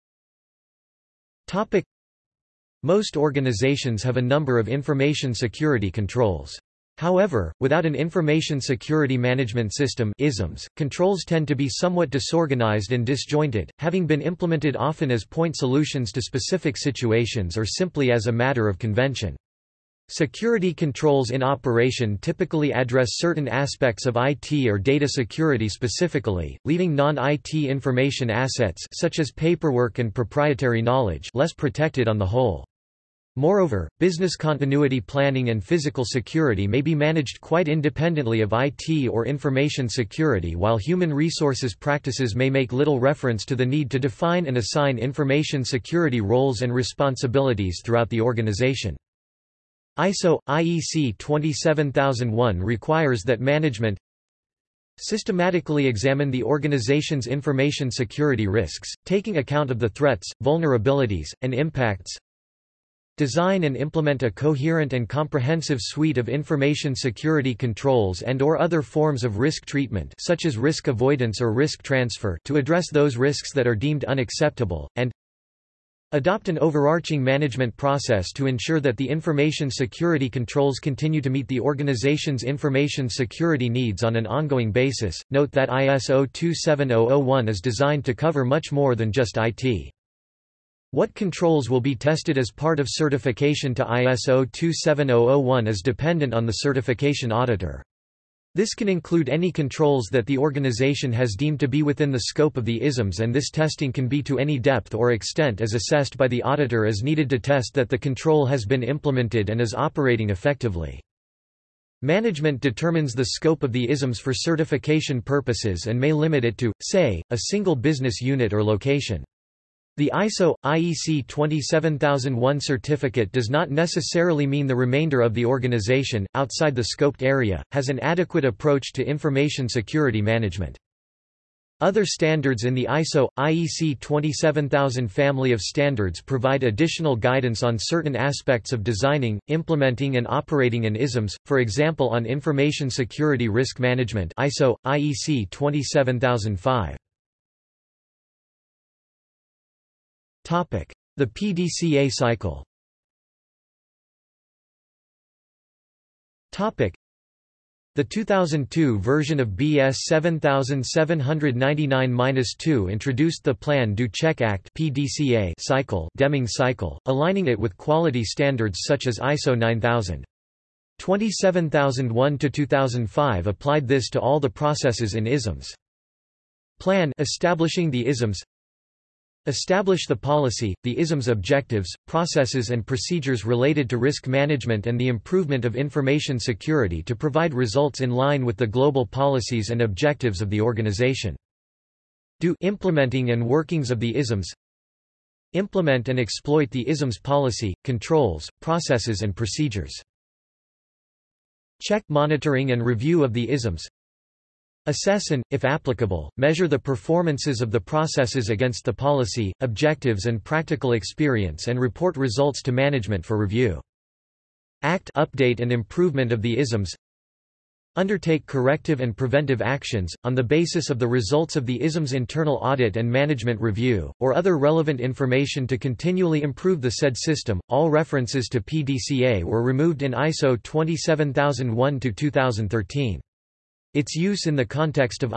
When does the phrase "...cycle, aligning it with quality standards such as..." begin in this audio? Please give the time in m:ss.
2:46.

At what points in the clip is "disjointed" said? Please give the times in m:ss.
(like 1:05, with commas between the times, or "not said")
0:13.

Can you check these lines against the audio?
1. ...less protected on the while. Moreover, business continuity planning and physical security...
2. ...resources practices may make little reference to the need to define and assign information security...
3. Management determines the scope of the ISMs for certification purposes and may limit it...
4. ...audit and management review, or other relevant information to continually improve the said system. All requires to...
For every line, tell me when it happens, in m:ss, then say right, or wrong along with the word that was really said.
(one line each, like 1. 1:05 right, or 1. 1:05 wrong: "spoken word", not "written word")
1. 0:31 wrong: "whole", not "while"
2. 0:41 right
3. 1:52 right
4. 3:42 wrong: "references", not "requires".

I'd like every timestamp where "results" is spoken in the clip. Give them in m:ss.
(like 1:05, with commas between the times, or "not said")
3:07, 3:32, 3:41.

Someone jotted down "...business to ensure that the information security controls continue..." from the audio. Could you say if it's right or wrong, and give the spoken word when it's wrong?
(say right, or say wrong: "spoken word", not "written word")
wrong: "process", not "business".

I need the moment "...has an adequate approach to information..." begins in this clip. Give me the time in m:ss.
2:07.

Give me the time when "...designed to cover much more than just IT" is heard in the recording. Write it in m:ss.
1:27.